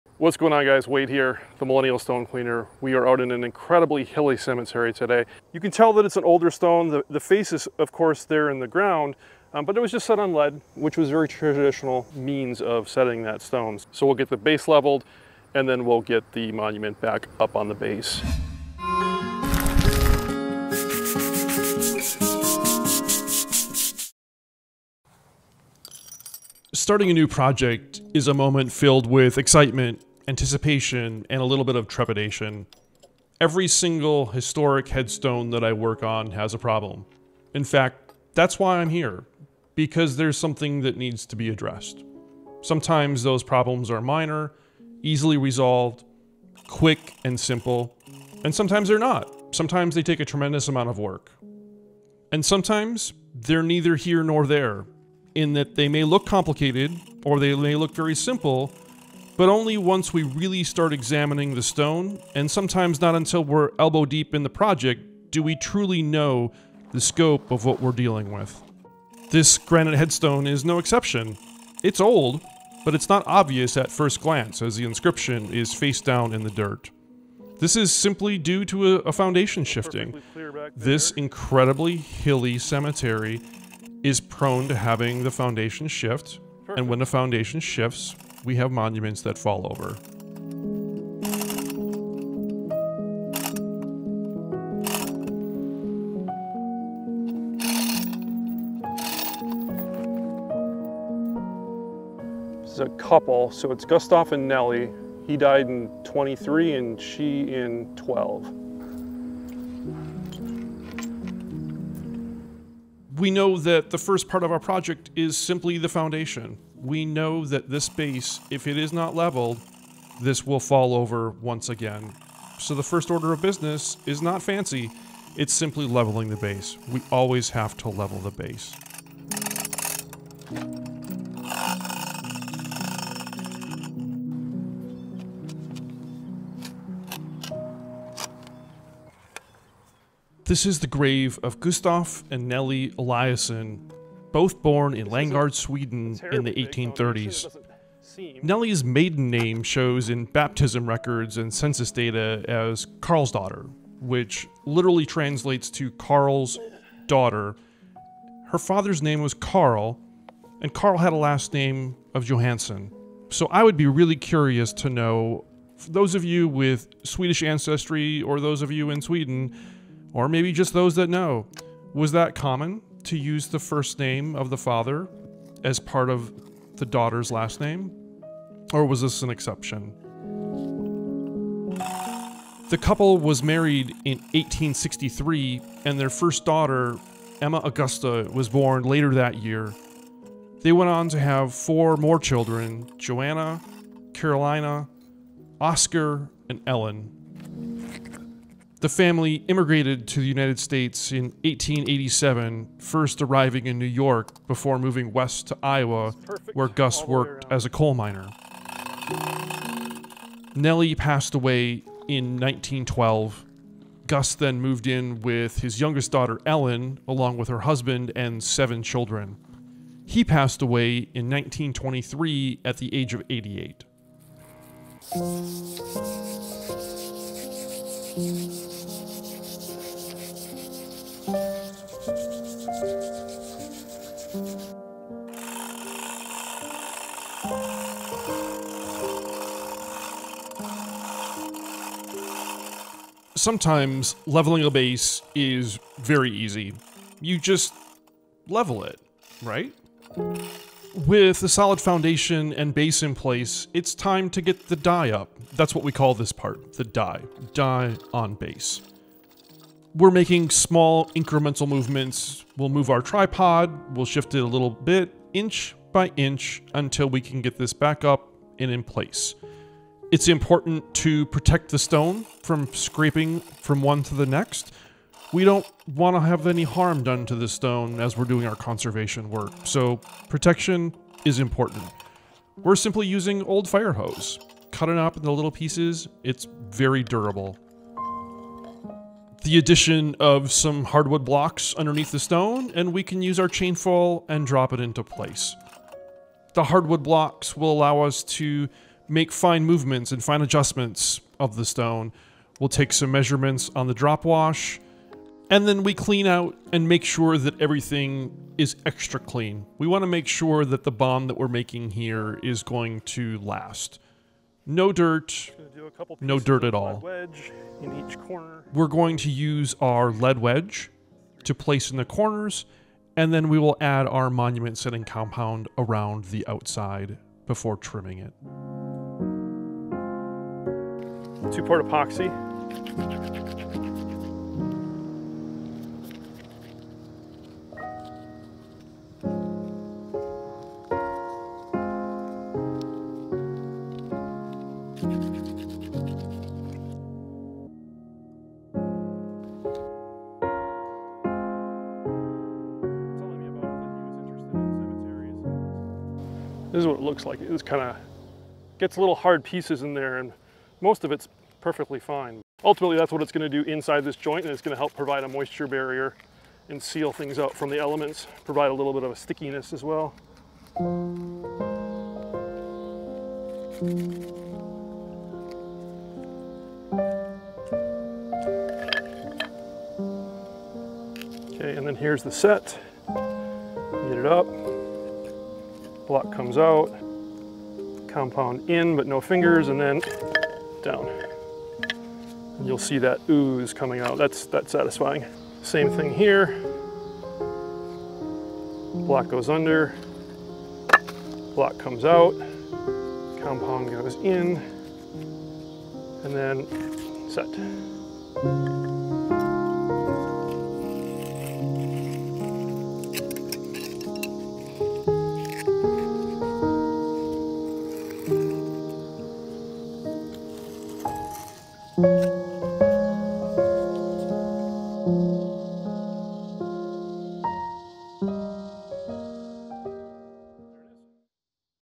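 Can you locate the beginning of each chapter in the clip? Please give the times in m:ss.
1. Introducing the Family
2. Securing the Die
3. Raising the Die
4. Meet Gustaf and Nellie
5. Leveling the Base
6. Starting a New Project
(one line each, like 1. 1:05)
1. 2:22
2. 5:24
3. 4:18
4. 1:44
5. 2:04
6. 0:28.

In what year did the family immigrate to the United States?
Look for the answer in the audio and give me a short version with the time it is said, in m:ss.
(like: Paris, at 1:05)
1887, at 3:21.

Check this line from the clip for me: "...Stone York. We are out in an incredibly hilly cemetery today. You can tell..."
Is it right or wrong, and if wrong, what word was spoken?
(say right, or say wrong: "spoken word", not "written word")
wrong: "Cleaner", not "York".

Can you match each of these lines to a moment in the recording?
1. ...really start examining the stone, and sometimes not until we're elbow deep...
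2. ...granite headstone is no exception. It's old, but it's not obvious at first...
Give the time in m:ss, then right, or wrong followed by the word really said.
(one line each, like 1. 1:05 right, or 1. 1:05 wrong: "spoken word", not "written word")
1. 1:00 right
2. 1:09 right.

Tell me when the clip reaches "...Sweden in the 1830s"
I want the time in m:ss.
2:25.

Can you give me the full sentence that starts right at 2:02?
So the first order of business is not fancy, it's simply leveling the base.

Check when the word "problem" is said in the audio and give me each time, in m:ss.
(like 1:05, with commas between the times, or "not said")
0:36, 0:43.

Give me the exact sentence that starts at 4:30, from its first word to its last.
It's important to protect the stone from scraping from one to the next.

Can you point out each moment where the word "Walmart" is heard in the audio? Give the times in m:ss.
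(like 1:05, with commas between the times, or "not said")
not said.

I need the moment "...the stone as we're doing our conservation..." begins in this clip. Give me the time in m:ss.
4:37.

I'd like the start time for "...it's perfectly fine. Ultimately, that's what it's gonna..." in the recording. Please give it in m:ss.
6:01.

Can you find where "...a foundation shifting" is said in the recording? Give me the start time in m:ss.
1:18.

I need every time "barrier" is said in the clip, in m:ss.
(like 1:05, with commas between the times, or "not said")
6:05.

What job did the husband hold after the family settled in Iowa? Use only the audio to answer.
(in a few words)
coal miner.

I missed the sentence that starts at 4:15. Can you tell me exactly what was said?
That's what we call this part, the die.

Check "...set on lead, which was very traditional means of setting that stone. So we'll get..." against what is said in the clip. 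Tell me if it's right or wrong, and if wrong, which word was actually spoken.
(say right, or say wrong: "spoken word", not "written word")
right.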